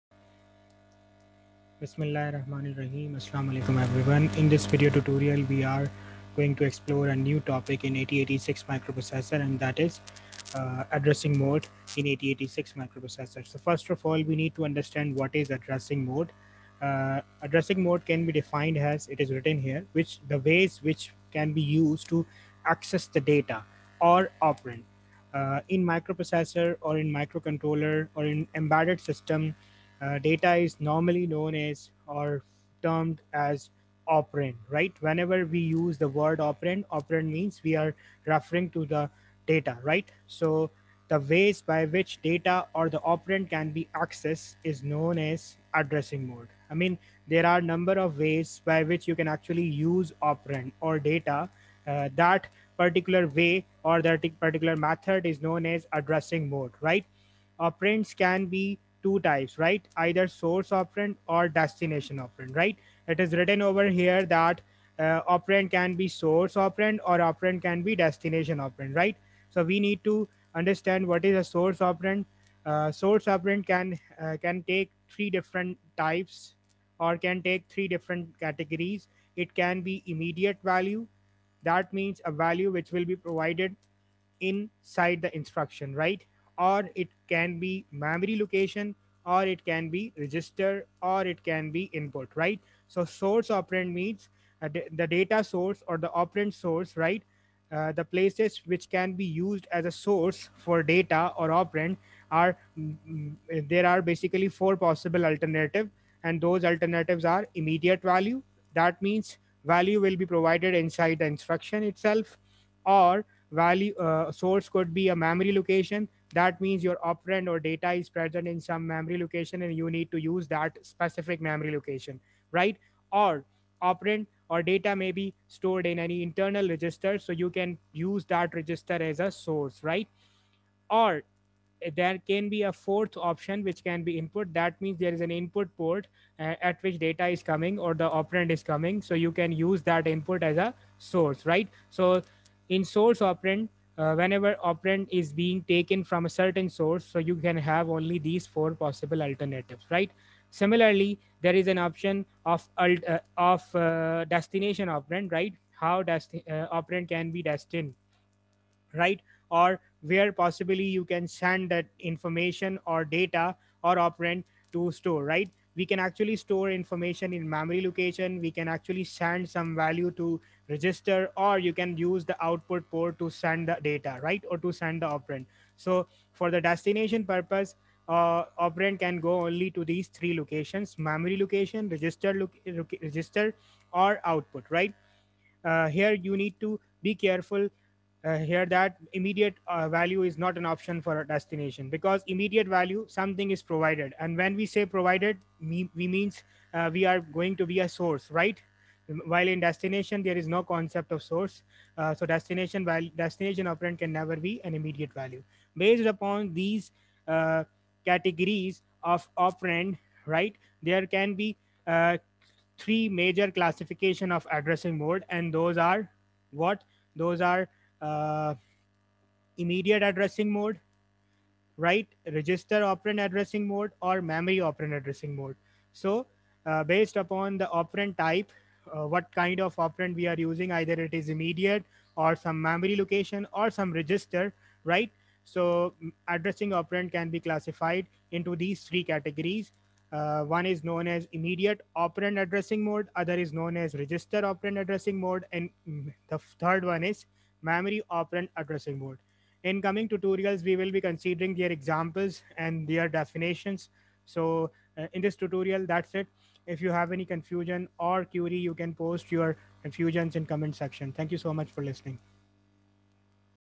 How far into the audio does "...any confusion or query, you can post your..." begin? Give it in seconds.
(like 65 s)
257 s.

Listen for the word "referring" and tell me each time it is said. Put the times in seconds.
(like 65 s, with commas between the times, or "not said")
38 s.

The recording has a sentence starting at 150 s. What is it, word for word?
Similarly, there is an option of alt, uh, of uh, destination operand, right?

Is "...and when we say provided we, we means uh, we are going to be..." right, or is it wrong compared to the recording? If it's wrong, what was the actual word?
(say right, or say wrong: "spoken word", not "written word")
right.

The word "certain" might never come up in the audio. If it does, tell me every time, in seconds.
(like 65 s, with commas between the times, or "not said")
146 s.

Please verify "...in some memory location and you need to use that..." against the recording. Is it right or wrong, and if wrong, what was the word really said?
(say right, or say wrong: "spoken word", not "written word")
right.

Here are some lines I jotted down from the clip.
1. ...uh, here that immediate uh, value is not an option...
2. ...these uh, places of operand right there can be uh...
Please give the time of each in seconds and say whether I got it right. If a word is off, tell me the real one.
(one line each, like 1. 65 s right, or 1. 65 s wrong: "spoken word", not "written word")
1. 188 s right
2. 206 s wrong: "categories", not "places".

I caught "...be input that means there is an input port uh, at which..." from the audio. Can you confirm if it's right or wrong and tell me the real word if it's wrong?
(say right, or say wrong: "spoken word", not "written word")
right.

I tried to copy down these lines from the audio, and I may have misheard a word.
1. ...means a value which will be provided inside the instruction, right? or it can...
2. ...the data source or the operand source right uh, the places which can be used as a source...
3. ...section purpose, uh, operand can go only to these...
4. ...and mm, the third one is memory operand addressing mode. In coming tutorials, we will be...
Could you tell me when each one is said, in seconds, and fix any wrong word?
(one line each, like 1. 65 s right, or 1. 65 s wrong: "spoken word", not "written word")
1. 81 s right
2. 95 s right
3. 176 s wrong: "destination", not "section"
4. 245 s right.